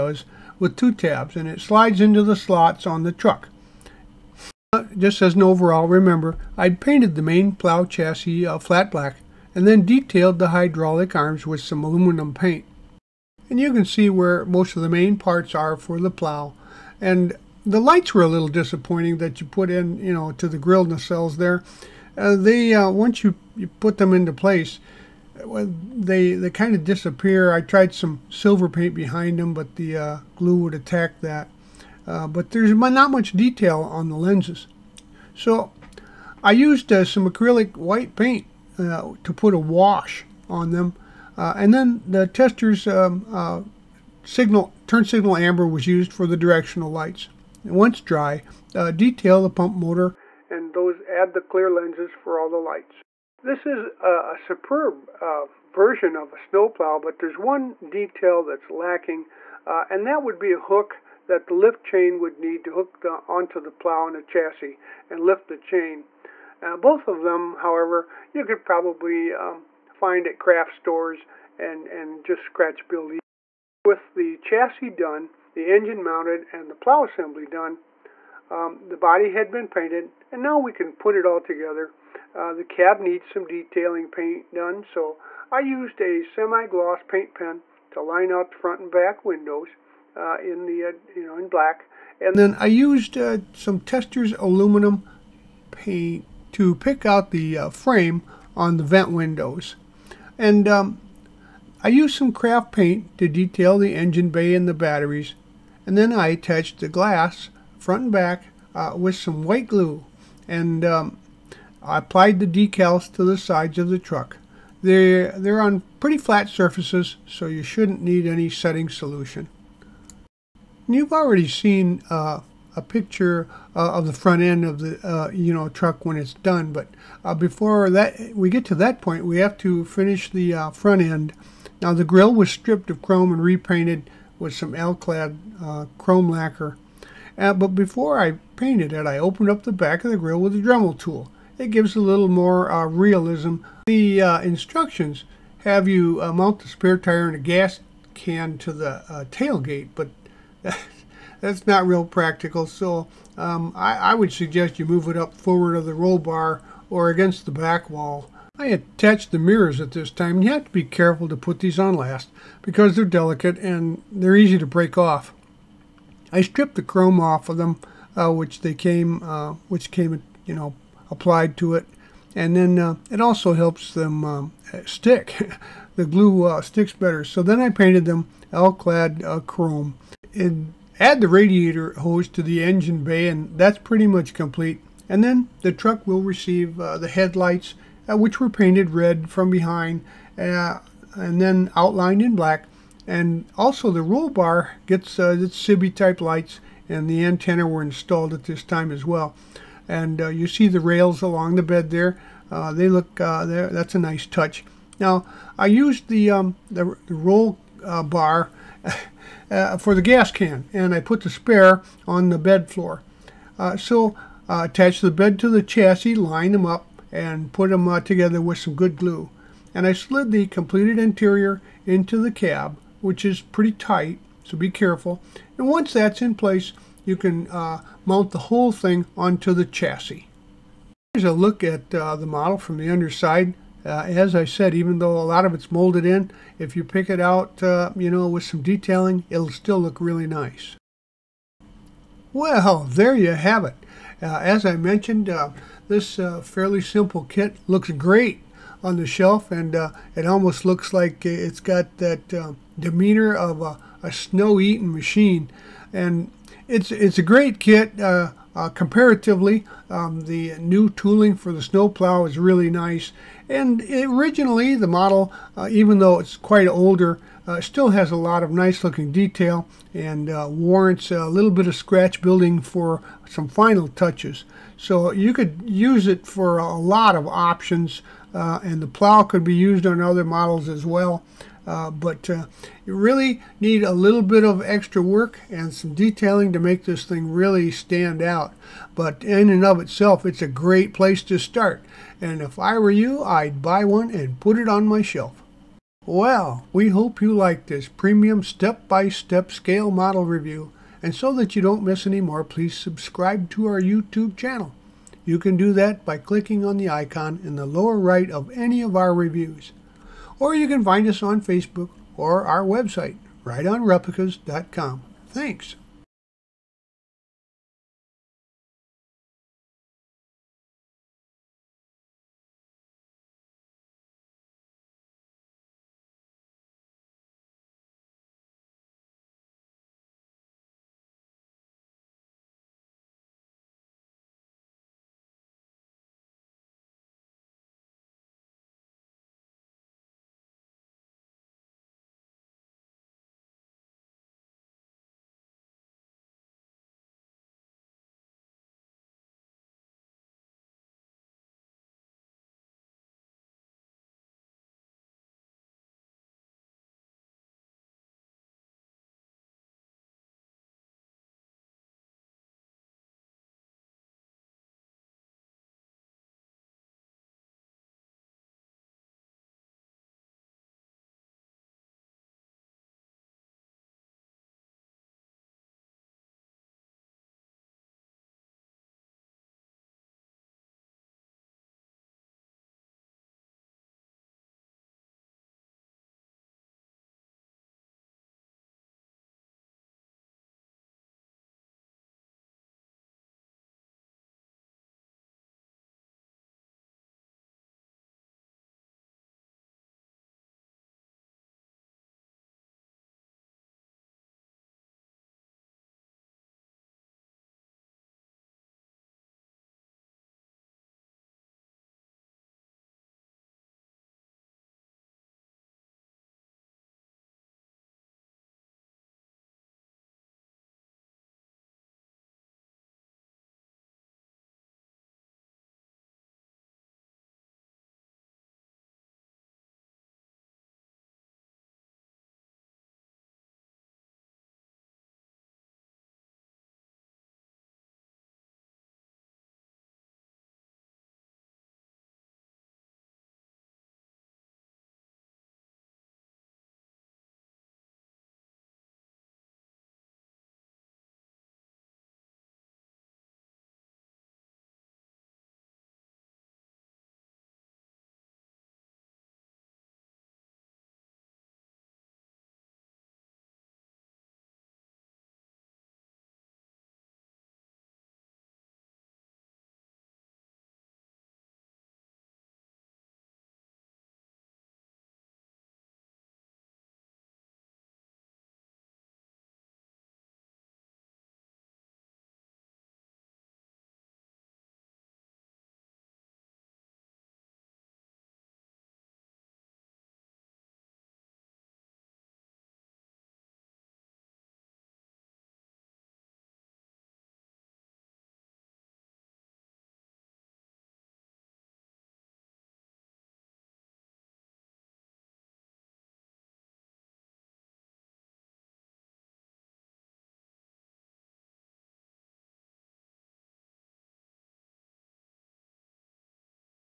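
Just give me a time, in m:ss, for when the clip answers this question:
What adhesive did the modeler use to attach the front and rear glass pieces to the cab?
1:49.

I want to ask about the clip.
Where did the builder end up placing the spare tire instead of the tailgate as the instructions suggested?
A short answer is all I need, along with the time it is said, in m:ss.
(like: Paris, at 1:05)
the bed floor, at 3:32.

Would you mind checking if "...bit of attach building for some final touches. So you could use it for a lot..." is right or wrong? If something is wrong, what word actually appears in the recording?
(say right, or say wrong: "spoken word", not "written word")
wrong: "scratch", not "attach".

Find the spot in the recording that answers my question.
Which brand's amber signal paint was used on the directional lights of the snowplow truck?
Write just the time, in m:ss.
0:42.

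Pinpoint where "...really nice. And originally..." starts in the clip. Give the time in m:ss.
4:22.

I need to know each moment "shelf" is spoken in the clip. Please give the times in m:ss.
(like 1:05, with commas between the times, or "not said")
4:09, 4:55.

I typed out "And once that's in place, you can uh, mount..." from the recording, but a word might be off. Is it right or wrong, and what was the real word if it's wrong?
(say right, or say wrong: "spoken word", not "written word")
right.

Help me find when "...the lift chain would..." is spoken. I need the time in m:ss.
1:01.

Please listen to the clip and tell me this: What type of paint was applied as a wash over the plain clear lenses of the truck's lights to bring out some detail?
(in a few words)
acrylic white paint.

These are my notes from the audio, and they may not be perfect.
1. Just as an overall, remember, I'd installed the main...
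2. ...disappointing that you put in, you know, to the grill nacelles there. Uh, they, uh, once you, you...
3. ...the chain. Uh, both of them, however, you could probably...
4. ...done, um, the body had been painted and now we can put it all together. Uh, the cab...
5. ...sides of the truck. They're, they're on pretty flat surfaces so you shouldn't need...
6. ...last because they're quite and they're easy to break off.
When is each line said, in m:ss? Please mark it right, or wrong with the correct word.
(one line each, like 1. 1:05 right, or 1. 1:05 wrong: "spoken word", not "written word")
1. 0:04 wrong: "painted", not "installed"
2. 0:18 right
3. 1:05 right
4. 1:17 right
5. 1:53 right
6. 2:41 wrong: "delicate", not "quite".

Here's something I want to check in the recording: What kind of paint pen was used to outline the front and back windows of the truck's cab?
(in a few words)
semi-gloss paint pen.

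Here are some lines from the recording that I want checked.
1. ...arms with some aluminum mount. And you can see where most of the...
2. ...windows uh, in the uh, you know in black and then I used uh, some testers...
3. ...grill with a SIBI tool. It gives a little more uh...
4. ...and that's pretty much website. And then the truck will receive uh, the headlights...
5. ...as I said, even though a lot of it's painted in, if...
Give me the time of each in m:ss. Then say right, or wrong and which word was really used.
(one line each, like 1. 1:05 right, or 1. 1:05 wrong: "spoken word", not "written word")
1. 0:11 wrong: "paint", not "mount"
2. 1:29 right
3. 2:20 wrong: "Dremel", not "SIBI"
4. 3:03 wrong: "complete", not "website"
5. 3:54 wrong: "molded", not "painted".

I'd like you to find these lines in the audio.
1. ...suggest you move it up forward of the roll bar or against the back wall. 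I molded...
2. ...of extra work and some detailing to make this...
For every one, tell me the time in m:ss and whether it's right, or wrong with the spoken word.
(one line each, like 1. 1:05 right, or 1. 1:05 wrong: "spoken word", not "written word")
1. 2:34 wrong: "attached", not "molded"
2. 4:44 right.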